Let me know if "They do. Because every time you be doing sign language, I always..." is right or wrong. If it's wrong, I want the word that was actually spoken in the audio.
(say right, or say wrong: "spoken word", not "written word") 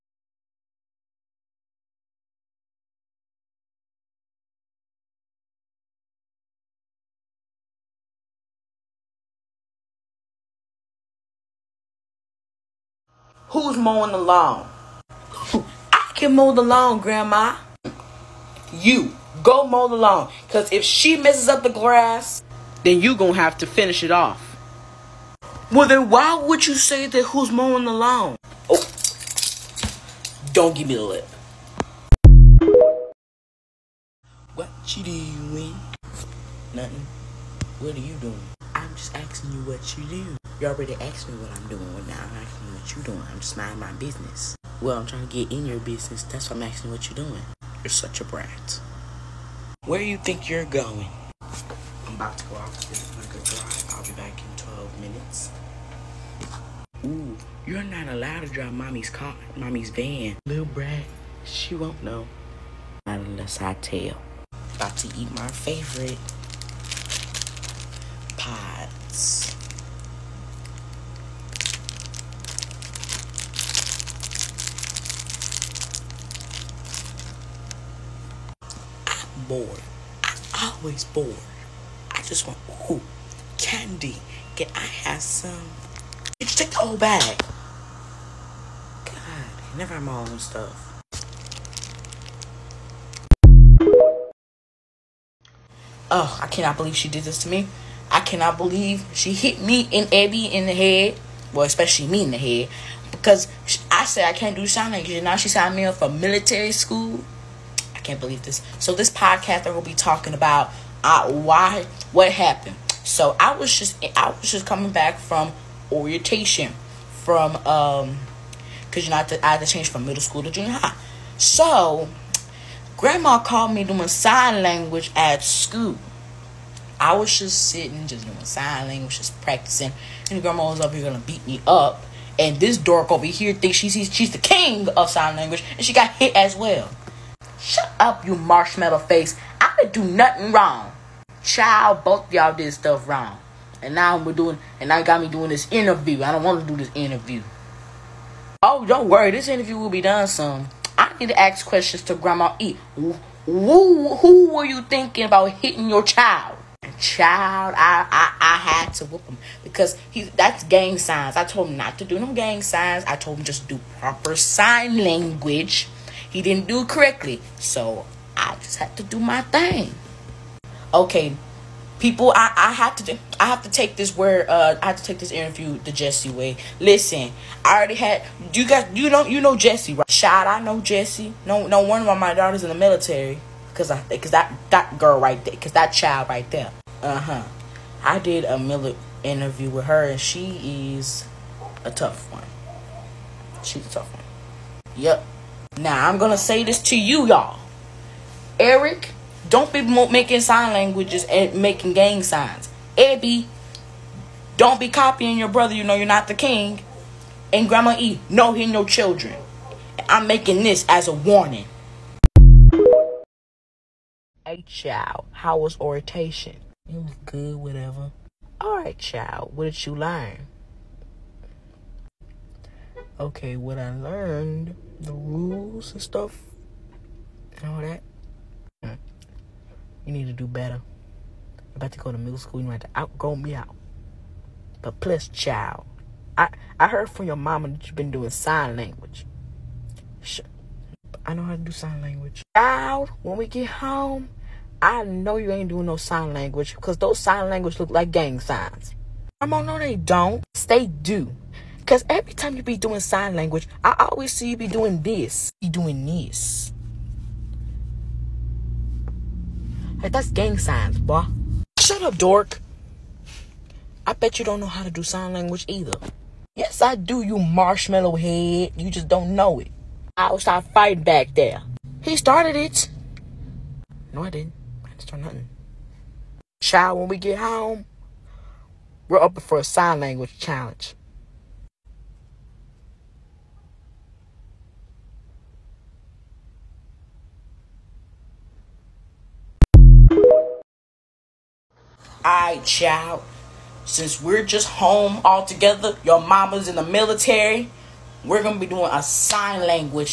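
right.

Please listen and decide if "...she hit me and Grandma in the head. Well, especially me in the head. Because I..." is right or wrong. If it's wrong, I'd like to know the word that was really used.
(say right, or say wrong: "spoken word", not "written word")
wrong: "Abby", not "Grandma".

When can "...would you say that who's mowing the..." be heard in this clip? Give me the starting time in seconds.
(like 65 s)
26 s.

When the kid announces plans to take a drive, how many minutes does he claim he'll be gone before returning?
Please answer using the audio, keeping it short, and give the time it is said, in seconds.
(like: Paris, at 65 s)
12 minutes, at 54 s.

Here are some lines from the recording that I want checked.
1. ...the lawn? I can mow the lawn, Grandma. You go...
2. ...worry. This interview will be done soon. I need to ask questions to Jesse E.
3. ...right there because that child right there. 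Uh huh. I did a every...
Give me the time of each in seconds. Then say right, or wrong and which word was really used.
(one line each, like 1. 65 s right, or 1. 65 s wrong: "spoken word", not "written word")
1. 14 s right
2. 149 s wrong: "Grandma", not "Jesse"
3. 185 s wrong: "military", not "every".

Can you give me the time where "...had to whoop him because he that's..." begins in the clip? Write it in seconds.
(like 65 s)
158 s.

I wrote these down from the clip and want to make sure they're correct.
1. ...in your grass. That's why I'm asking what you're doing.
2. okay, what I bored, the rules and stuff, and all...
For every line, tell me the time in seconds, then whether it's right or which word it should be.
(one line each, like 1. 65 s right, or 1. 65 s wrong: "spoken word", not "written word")
1. 45 s wrong: "business", not "grass"
2. 223 s wrong: "learned", not "bored".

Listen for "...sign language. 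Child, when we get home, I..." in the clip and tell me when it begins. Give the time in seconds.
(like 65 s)
241 s.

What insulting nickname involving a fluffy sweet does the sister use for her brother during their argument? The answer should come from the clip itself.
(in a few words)
marshmallow head.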